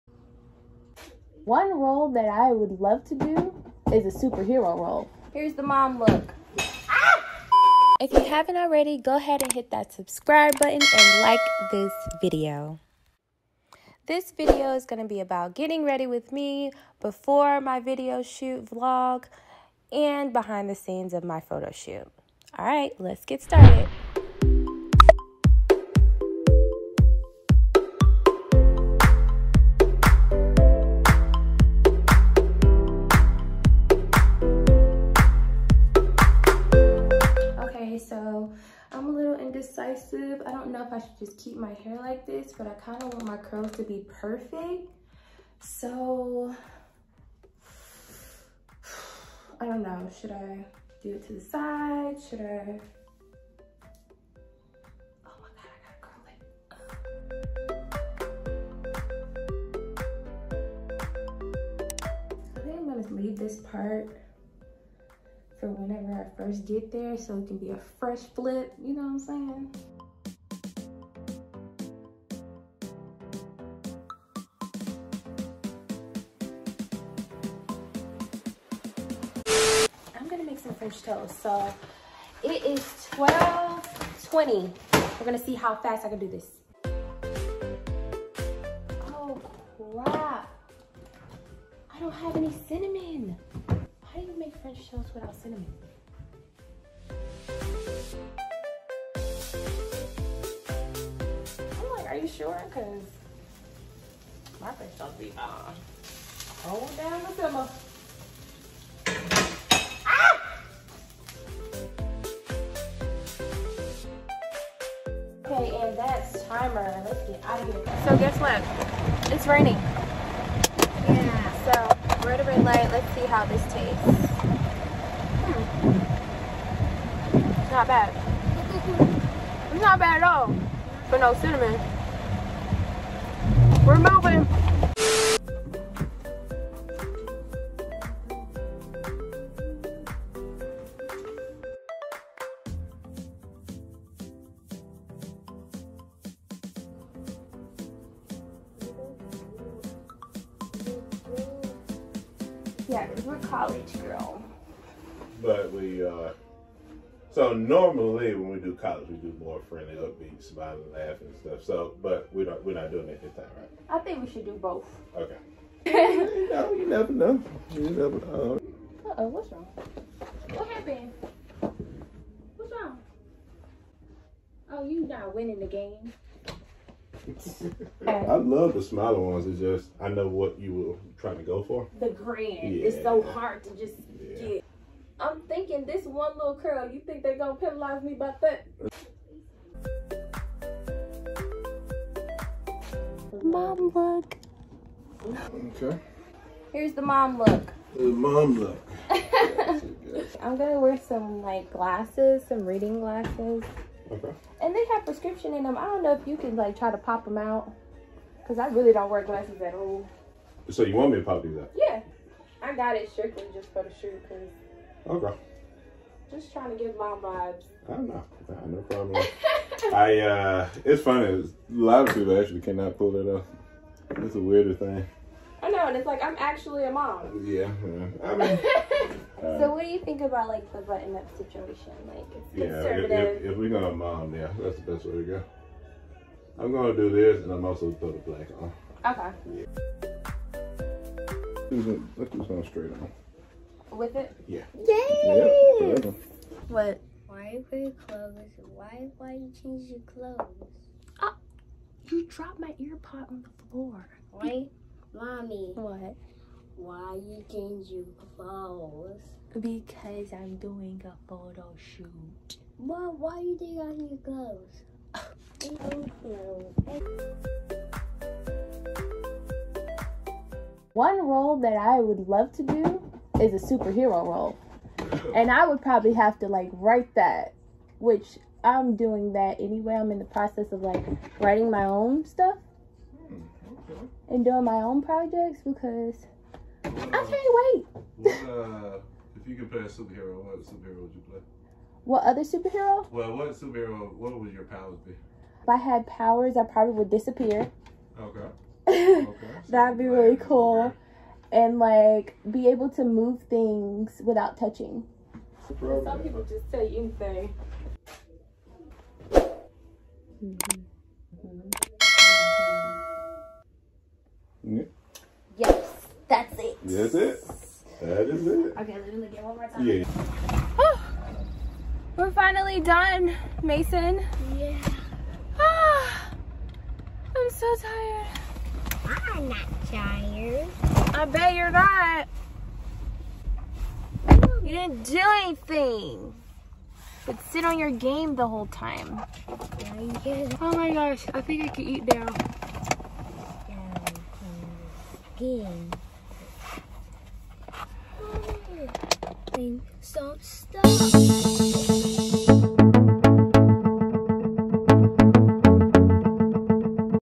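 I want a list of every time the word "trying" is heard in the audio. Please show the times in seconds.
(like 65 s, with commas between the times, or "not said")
181 s, 216 s.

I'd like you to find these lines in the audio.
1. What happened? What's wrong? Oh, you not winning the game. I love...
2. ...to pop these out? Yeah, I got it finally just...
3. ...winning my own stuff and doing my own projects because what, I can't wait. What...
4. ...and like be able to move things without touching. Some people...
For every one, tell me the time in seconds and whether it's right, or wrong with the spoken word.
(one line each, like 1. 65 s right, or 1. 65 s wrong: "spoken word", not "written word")
1. 170 s right
2. 211 s wrong: "strictly", not "finally"
3. 281 s wrong: "writing", not "winning"
4. 301 s right.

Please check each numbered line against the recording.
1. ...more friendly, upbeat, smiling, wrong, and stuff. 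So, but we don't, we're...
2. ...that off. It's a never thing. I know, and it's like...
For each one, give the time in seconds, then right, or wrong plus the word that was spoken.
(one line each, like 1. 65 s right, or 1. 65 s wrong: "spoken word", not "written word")
1. 159 s wrong: "laughing", not "wrong"
2. 223 s wrong: "weirder", not "never".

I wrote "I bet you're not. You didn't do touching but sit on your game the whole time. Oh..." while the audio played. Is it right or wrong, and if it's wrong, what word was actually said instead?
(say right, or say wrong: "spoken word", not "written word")
wrong: "anything", not "touching".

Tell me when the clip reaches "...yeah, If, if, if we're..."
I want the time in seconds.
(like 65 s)
232 s.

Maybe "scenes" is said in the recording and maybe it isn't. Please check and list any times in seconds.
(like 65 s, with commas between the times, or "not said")
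20 s.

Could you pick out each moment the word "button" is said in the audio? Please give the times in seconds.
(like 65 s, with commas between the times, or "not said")
10 s, 230 s.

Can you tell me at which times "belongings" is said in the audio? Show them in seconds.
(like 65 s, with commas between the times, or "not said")
not said.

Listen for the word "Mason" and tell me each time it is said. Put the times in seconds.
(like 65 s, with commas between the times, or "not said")
323 s.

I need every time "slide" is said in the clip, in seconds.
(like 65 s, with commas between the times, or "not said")
not said.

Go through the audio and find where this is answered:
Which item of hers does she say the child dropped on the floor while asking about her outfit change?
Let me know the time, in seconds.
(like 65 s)
252 s.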